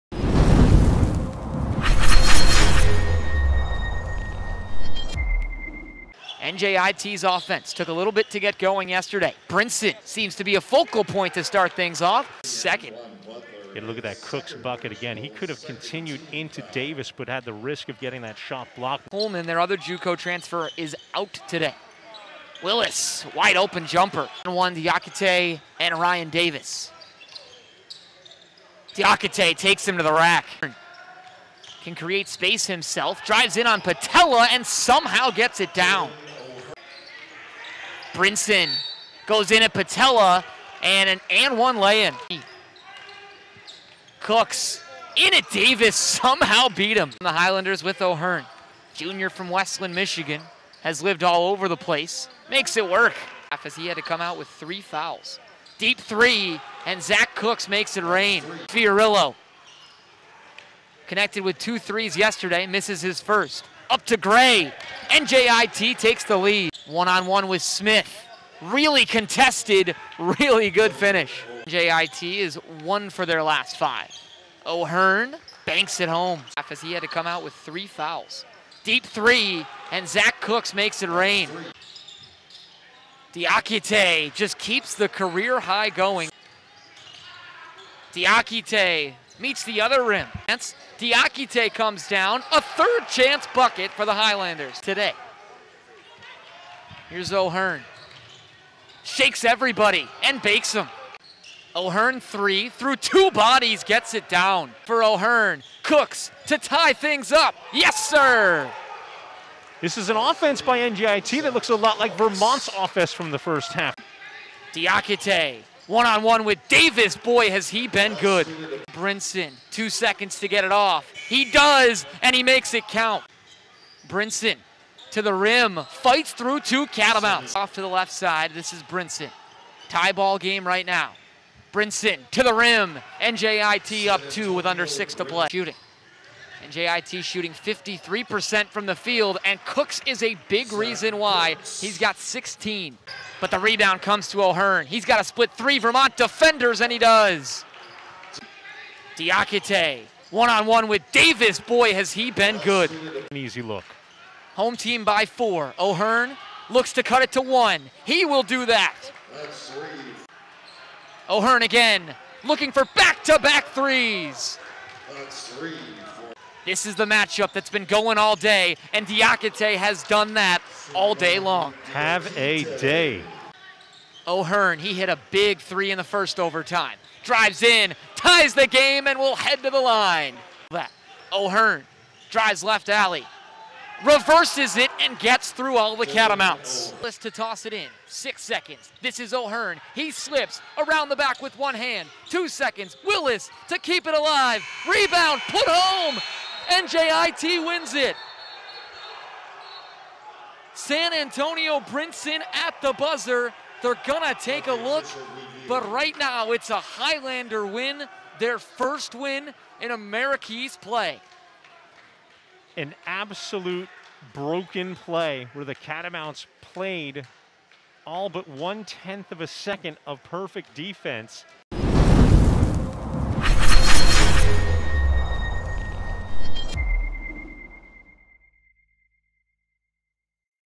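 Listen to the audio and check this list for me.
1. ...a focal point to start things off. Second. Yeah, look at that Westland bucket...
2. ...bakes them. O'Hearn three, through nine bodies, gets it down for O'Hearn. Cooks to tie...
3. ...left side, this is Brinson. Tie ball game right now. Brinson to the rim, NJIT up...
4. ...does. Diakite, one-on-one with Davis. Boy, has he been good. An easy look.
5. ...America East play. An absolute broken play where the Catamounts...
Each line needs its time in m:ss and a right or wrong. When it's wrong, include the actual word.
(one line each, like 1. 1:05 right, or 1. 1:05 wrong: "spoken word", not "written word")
1. 0:10 wrong: "Cooks", not "Westland"
2. 1:40 wrong: "two", not "nine"
3. 2:07 right
4. 2:26 right
5. 3:29 right.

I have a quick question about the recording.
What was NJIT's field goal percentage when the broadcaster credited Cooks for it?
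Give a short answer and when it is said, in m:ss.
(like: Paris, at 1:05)
53%, at 2:17.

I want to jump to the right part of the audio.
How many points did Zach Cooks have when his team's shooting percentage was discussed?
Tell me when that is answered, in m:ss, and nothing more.
2:22.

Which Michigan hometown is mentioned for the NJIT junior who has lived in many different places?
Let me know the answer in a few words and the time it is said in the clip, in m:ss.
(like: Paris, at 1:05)
Westland, Michigan, at 0:49.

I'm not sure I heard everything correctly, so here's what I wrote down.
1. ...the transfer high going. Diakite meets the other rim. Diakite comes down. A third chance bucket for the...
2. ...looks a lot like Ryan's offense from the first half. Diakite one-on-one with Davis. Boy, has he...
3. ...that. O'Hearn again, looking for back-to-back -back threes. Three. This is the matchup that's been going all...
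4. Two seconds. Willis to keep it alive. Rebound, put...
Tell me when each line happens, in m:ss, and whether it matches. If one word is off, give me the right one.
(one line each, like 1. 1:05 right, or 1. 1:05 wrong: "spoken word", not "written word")
1. 1:24 wrong: "career", not "transfer"
2. 1:51 wrong: "Vermont", not "Ryan"
3. 2:38 right
4. 3:12 right.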